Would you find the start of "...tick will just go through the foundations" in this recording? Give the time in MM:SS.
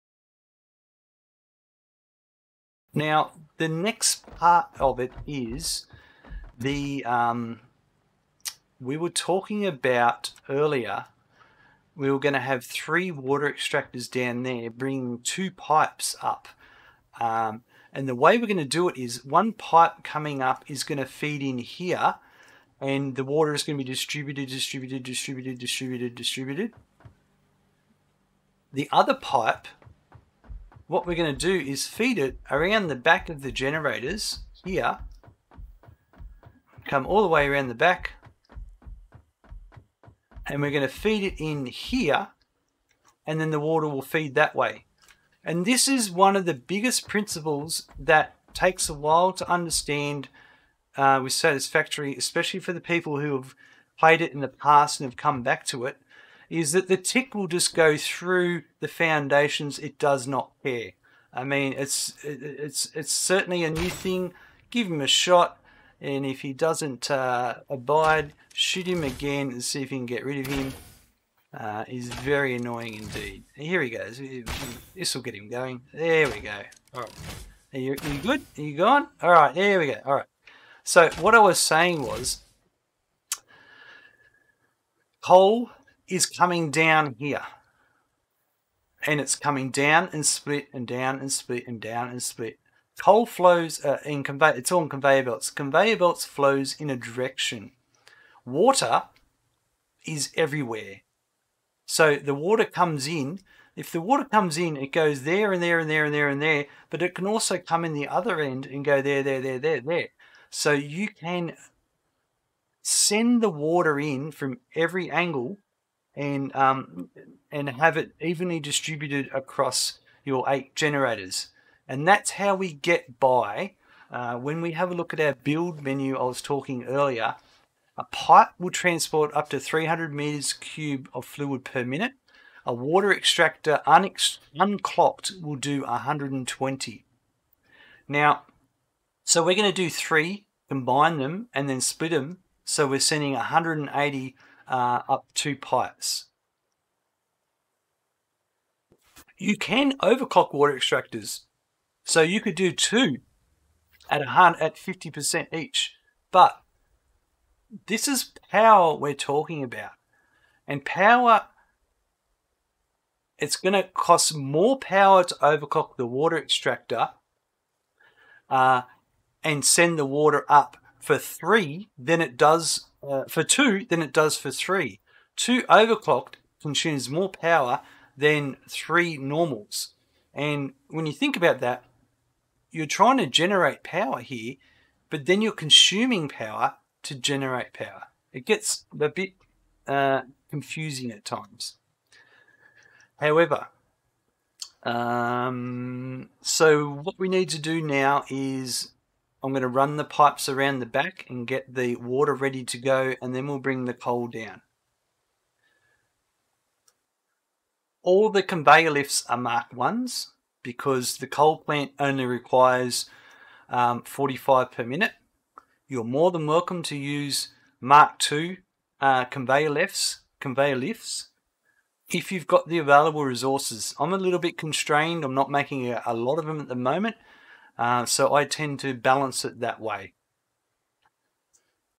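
00:56.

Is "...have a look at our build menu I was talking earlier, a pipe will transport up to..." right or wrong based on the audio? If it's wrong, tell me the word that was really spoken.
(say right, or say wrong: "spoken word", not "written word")
right.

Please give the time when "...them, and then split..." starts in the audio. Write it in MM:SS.
02:21.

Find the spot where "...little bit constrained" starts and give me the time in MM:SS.
03:44.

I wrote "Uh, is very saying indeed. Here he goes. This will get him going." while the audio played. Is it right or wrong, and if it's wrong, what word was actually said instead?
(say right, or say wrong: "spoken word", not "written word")
wrong: "annoying", not "saying".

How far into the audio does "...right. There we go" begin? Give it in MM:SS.
01:19.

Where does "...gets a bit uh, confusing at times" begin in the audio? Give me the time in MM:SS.
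03:08.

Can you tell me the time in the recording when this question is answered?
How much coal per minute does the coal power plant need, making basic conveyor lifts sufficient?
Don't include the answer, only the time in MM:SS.
03:34.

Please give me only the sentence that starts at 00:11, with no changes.
We were going to have three water extractors down there, bringing two pipes up.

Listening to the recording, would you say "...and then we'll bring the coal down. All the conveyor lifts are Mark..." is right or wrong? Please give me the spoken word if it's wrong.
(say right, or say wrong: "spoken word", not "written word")
right.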